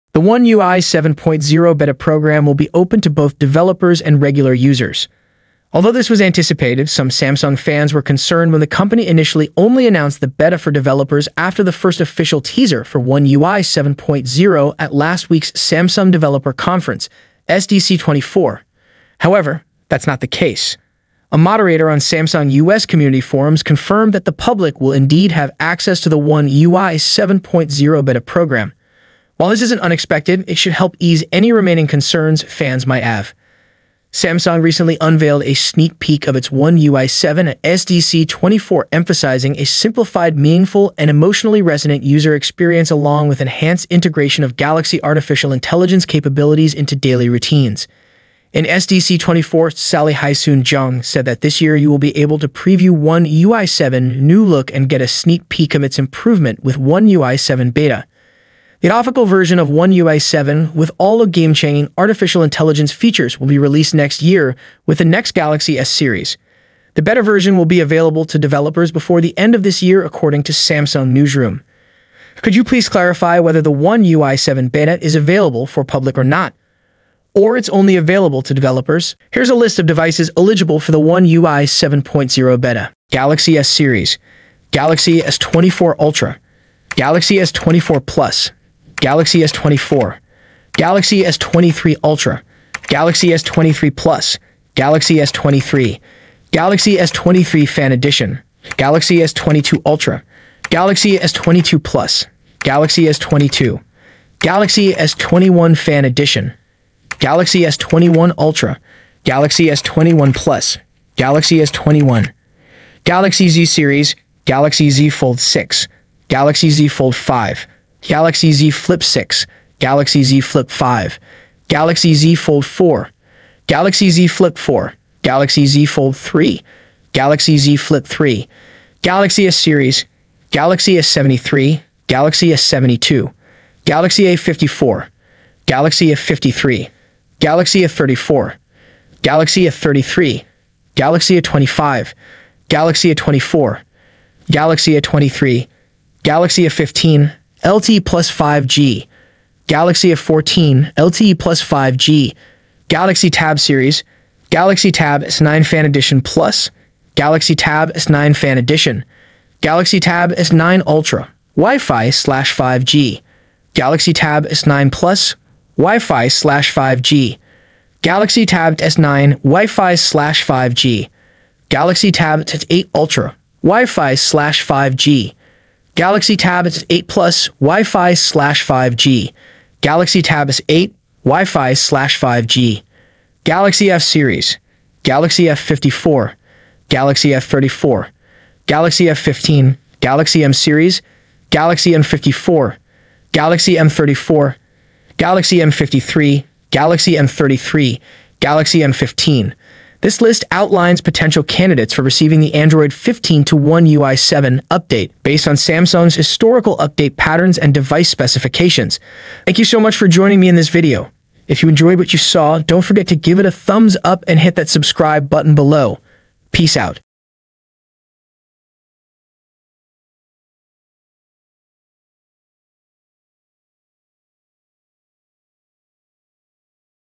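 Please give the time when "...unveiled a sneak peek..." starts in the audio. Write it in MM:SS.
00:35.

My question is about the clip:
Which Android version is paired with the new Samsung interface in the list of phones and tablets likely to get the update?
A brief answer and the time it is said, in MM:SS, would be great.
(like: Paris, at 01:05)
Android 15, at 03:22.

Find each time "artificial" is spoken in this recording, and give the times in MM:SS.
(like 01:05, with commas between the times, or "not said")
00:45, 01:01.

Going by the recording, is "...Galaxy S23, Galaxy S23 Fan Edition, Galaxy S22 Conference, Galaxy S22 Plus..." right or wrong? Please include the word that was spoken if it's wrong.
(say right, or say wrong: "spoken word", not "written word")
wrong: "Ultra", not "Conference".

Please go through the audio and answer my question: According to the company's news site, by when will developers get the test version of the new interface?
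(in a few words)
the end of this year.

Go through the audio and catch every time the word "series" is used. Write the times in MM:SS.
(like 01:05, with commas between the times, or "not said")
01:05, 01:23, 01:53, 02:09, 02:33, 03:04, 03:10.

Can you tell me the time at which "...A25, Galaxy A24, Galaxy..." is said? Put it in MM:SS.
02:21.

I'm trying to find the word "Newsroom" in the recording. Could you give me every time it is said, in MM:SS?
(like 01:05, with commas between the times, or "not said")
01:11.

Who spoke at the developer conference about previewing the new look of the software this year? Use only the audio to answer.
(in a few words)
Sally Hyesoon Jeong.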